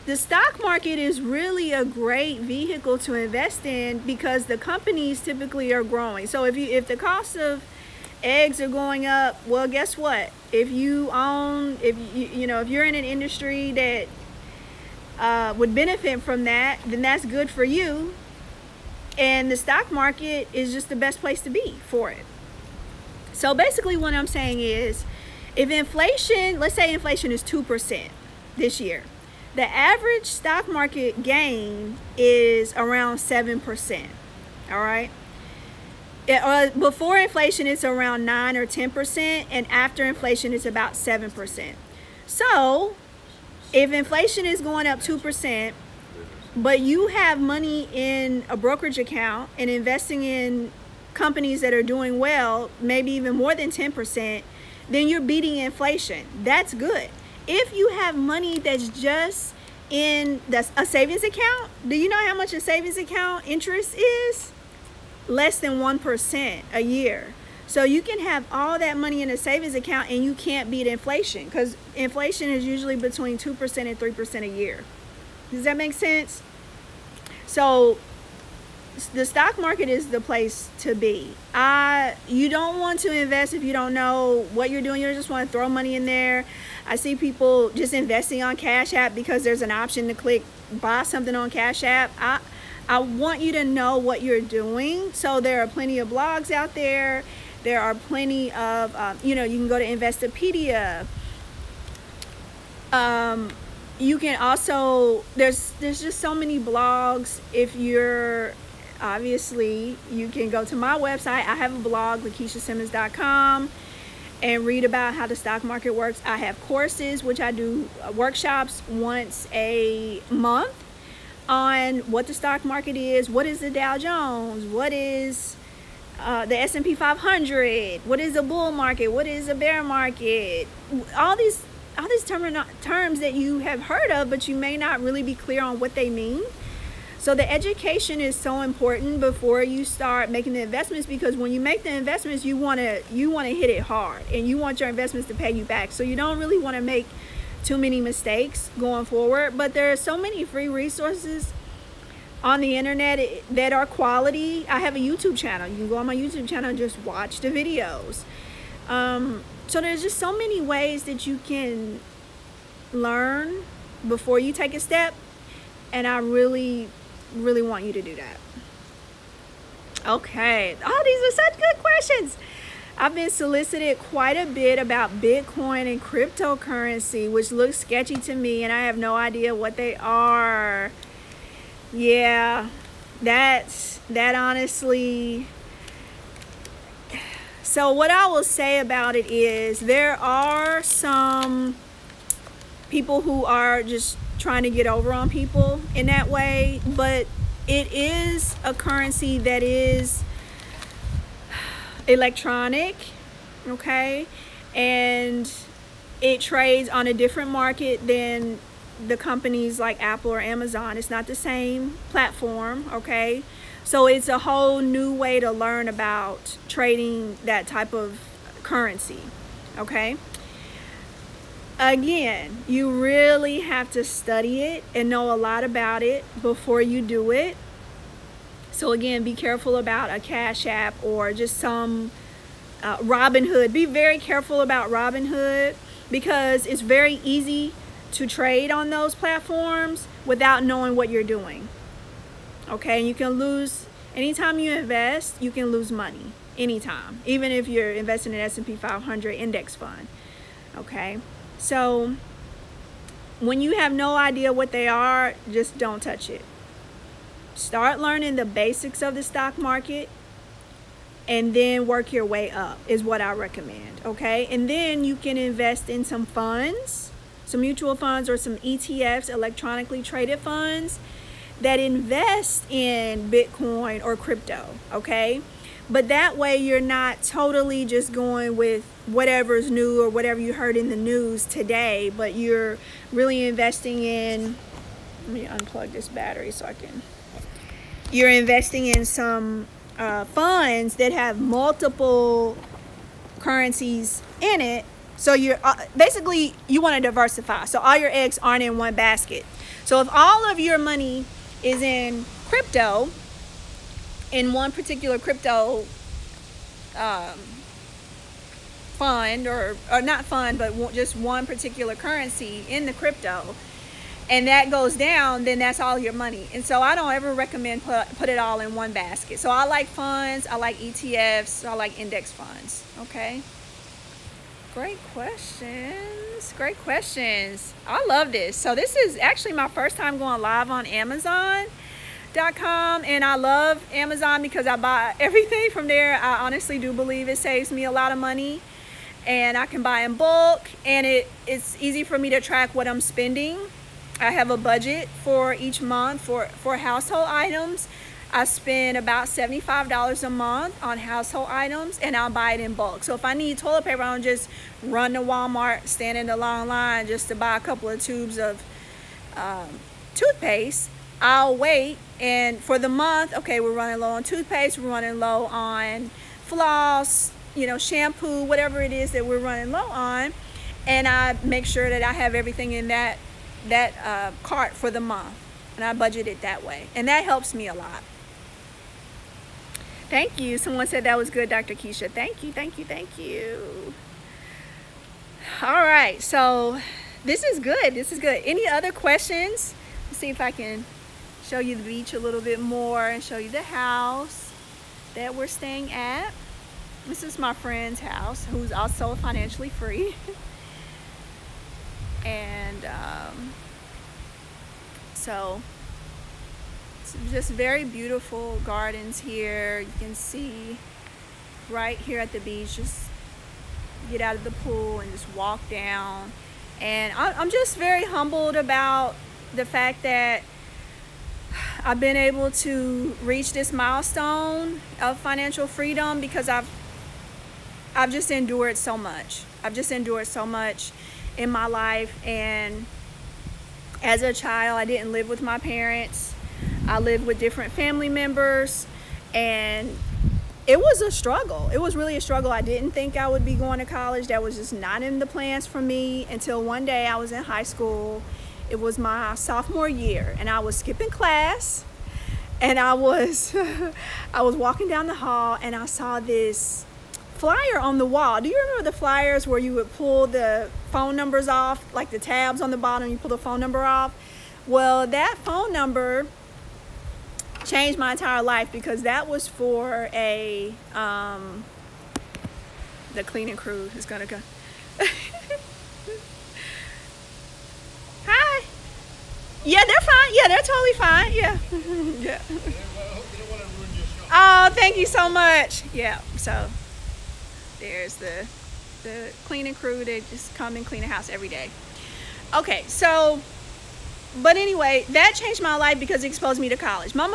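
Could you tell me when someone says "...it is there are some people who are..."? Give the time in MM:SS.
03:09.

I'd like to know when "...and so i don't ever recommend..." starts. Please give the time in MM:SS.
05:16.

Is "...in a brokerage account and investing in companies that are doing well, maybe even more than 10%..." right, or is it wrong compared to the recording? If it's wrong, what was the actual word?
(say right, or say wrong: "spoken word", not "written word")
right.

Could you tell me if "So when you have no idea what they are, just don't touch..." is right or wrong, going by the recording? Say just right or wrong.
right.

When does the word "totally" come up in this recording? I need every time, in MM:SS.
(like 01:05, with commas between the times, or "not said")
04:37, 08:00.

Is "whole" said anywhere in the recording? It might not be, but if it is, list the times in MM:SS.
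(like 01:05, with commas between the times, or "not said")
03:34.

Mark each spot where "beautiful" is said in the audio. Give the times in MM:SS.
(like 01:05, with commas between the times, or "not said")
06:47.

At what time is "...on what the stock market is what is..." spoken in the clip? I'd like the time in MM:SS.
02:01.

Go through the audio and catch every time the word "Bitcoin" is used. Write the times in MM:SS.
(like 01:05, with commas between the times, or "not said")
02:55, 04:33.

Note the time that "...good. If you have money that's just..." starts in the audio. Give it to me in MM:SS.
00:56.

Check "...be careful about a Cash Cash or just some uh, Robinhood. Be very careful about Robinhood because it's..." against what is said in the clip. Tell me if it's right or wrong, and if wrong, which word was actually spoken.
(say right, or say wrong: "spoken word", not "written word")
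wrong: "App", not "Cash".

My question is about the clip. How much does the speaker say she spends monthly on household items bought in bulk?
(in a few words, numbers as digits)
$75.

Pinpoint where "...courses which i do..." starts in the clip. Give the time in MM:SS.
01:56.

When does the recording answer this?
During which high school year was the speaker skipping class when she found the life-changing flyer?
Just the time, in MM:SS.
07:29.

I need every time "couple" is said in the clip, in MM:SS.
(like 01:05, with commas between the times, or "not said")
05:57.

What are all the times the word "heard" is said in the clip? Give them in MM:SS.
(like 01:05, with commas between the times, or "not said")
02:13, 04:40.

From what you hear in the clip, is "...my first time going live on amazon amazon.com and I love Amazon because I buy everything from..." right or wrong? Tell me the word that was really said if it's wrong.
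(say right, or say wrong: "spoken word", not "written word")
right.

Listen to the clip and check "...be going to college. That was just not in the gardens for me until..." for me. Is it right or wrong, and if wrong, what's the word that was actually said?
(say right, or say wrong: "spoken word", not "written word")
wrong: "plans", not "gardens".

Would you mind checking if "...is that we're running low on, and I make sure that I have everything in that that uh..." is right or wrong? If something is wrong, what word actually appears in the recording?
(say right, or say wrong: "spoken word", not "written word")
right.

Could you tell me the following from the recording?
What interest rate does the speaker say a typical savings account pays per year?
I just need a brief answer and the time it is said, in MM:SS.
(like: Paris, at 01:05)
Less than 1%, at 01:05.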